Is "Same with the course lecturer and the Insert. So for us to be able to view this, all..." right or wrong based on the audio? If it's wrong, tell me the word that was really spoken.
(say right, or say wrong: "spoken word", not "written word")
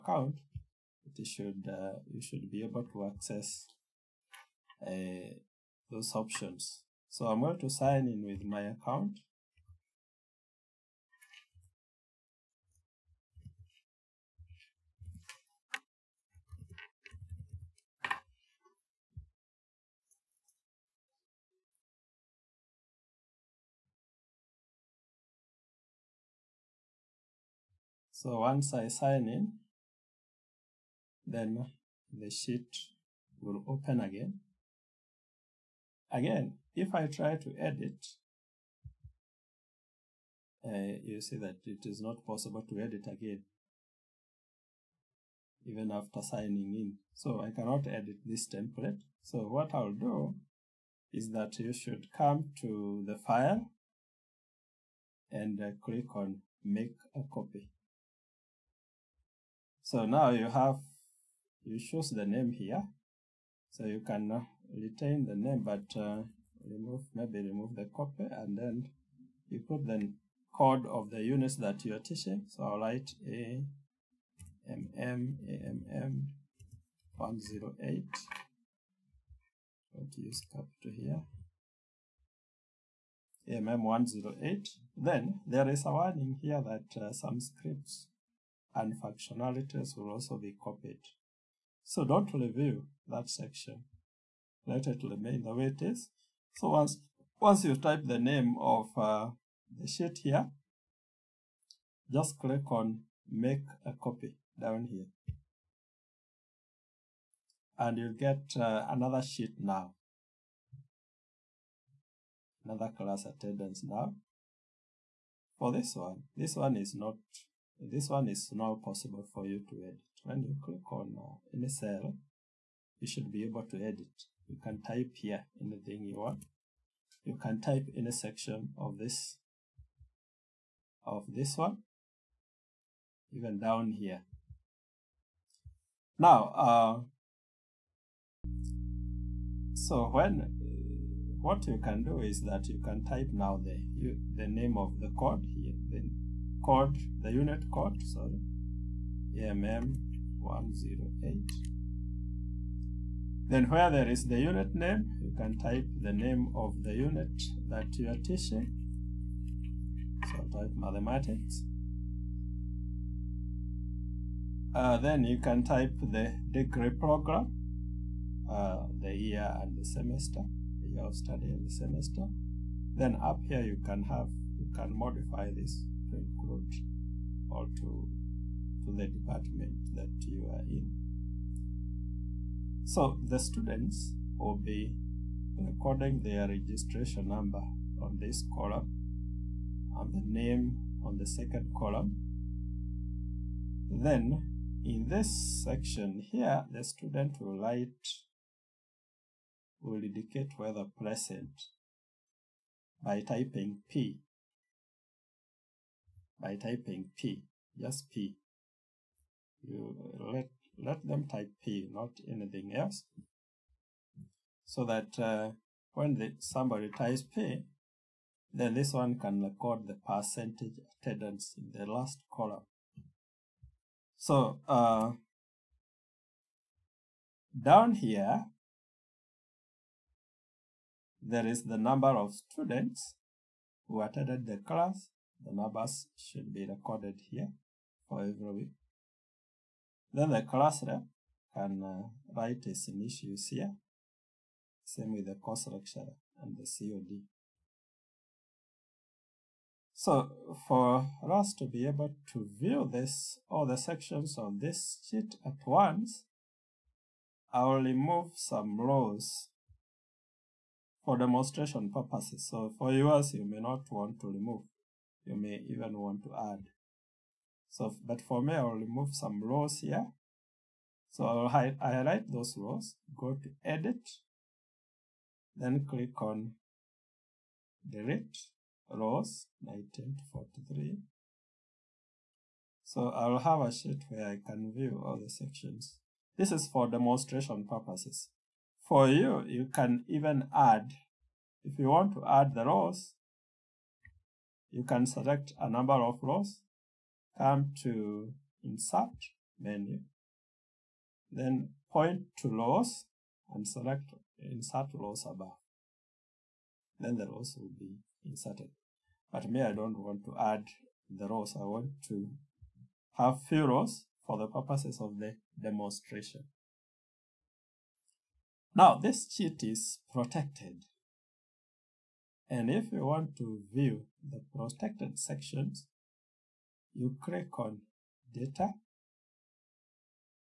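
wrong: "COD", not "Insert".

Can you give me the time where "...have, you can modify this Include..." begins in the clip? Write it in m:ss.
2:54.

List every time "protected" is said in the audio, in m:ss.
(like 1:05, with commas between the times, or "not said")
5:20, 5:24.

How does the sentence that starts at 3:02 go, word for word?
So the students will be recording their registration number on this column and the name on the second column.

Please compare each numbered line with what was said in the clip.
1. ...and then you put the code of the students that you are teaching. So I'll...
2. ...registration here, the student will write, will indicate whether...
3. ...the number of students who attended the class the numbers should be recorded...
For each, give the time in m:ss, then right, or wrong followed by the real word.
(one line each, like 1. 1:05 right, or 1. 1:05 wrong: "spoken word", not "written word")
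1. 1:08 wrong: "units", not "students"
2. 3:15 wrong: "section", not "registration"
3. 3:51 right.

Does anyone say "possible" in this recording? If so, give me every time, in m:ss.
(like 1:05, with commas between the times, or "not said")
0:42, 1:58.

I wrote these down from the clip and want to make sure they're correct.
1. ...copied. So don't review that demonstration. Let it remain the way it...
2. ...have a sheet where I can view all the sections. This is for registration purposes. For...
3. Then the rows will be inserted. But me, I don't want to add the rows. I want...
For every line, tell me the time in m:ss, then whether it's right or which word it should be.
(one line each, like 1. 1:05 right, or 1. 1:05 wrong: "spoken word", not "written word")
1. 1:30 wrong: "section", not "demonstration"
2. 4:43 wrong: "demonstration", not "registration"
3. 5:06 right.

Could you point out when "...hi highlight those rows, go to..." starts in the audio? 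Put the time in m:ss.
4:31.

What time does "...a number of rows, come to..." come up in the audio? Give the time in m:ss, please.
4:55.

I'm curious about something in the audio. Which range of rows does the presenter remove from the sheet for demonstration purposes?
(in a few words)
Rows 19 to 43.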